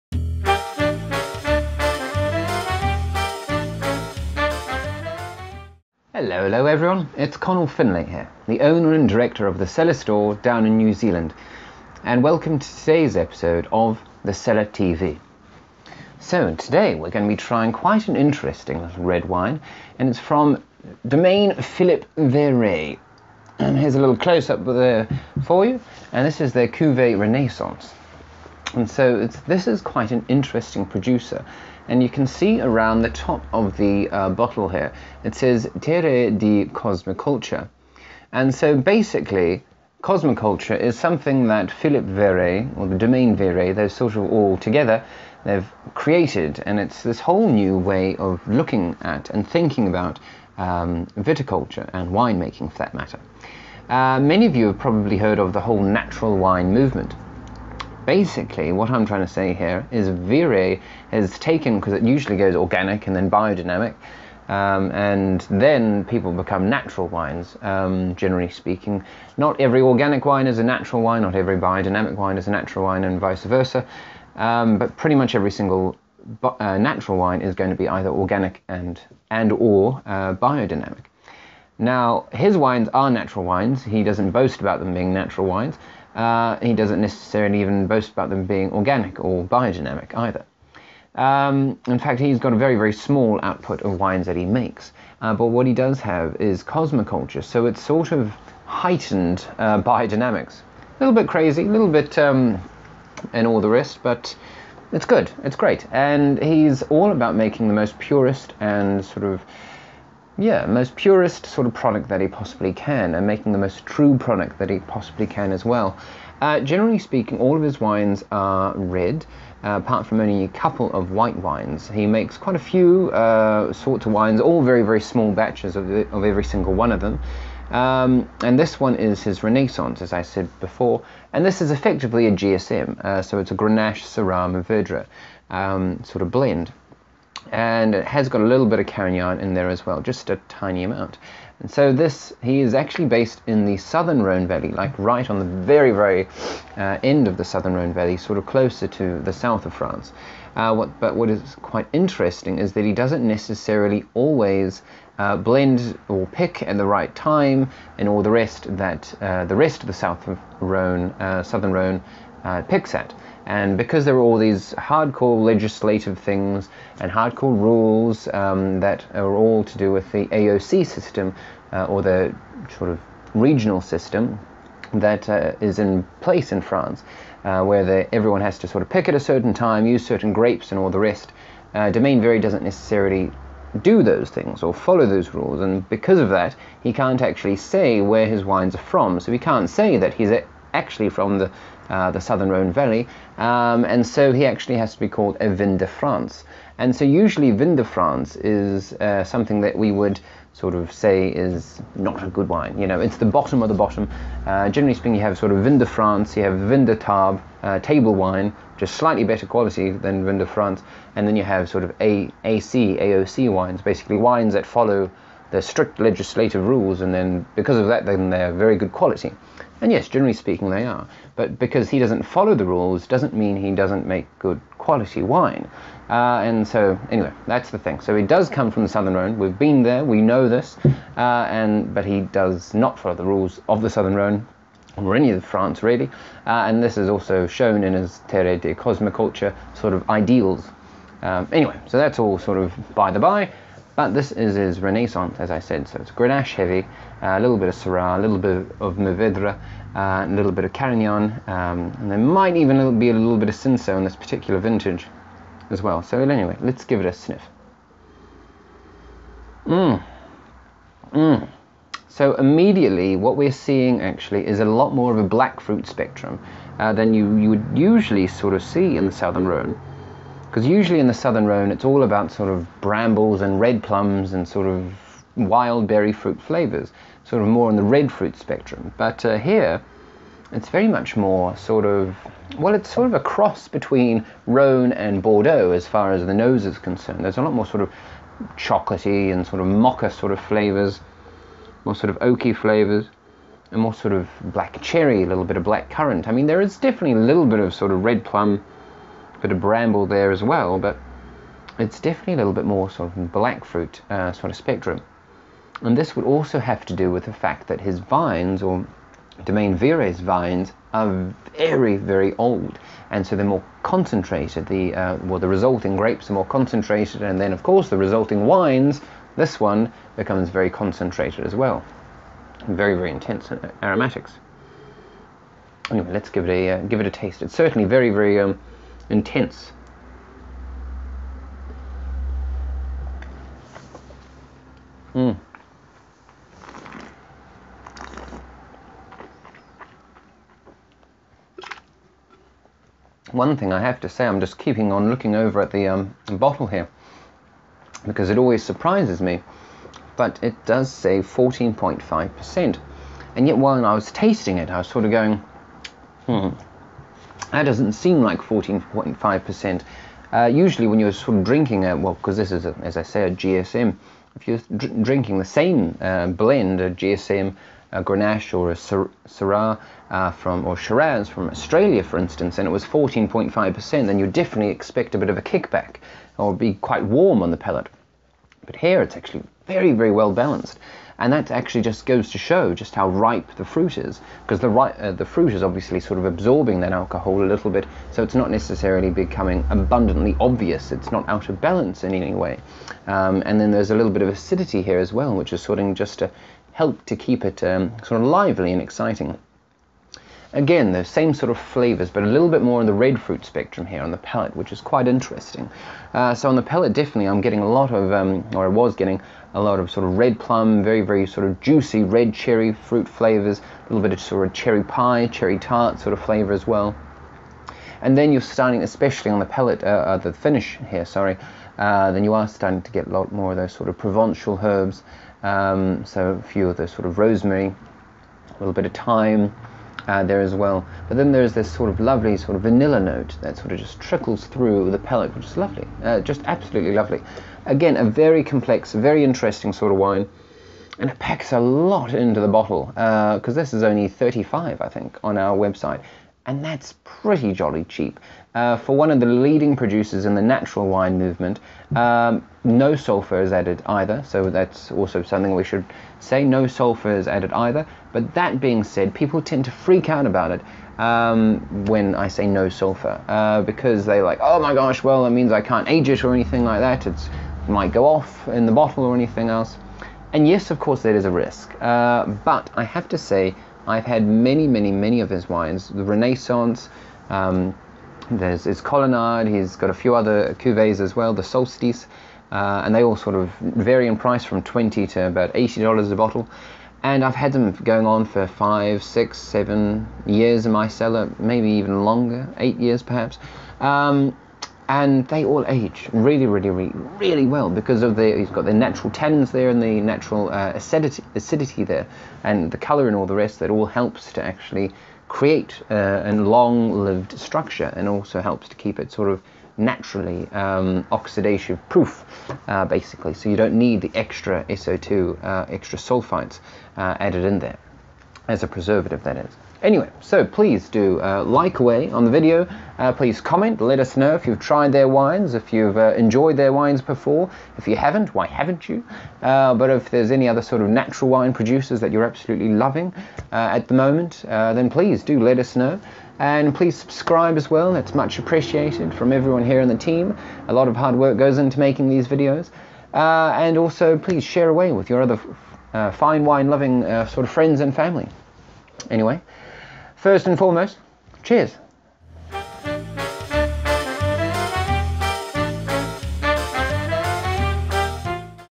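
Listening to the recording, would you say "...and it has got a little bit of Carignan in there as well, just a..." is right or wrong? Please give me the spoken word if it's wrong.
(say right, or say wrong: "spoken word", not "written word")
right.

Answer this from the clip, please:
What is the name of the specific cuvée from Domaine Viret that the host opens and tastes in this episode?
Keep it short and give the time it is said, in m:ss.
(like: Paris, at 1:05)
Cuvée Renaissance, at 0:26.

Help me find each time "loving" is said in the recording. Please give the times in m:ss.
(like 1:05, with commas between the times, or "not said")
8:52, 9:06.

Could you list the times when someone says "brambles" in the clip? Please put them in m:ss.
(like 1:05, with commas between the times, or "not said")
4:32, 4:59.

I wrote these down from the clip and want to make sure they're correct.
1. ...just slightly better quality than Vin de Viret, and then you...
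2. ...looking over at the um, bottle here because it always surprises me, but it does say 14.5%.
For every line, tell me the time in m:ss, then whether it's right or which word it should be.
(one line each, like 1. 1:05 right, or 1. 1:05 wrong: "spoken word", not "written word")
1. 3:28 wrong: "France", not "Viret"
2. 5:45 right.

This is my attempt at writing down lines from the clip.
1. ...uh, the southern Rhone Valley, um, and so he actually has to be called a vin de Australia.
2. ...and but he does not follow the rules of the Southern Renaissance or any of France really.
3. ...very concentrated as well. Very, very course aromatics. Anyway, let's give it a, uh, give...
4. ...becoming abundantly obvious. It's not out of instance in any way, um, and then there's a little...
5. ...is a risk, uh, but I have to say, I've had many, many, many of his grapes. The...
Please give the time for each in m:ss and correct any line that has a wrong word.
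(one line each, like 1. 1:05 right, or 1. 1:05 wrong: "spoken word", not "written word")
1. 3:11 wrong: "France", not "Australia"
2. 3:51 wrong: "Rhone", not "Renaissance"
3. 5:20 wrong: "intense", not "course"
4. 6:29 wrong: "balance", not "instance"
5. 7:51 wrong: "wines", not "grapes".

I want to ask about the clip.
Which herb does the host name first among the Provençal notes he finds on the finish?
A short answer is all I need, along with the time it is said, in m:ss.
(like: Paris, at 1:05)
rosemary, at 7:07.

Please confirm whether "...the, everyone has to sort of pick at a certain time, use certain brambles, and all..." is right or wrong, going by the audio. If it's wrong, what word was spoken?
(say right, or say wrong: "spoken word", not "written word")
wrong: "grapes", not "brambles".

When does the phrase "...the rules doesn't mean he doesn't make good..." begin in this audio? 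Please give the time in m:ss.
3:42.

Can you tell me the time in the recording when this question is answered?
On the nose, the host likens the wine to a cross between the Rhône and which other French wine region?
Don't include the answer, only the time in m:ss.
4:45.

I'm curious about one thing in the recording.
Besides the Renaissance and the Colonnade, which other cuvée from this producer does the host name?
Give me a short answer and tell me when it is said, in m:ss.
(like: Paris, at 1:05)
Solstice, at 8:01.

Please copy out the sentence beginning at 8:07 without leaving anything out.
And I've had them going on for five, six, seven years in my cellar, maybe even longer, eight years perhaps.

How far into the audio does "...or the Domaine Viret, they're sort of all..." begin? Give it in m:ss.
0:42.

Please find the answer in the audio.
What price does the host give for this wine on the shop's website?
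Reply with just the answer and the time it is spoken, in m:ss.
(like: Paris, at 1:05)
35, at 7:24.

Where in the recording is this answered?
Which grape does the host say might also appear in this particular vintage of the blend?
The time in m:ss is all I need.
4:13.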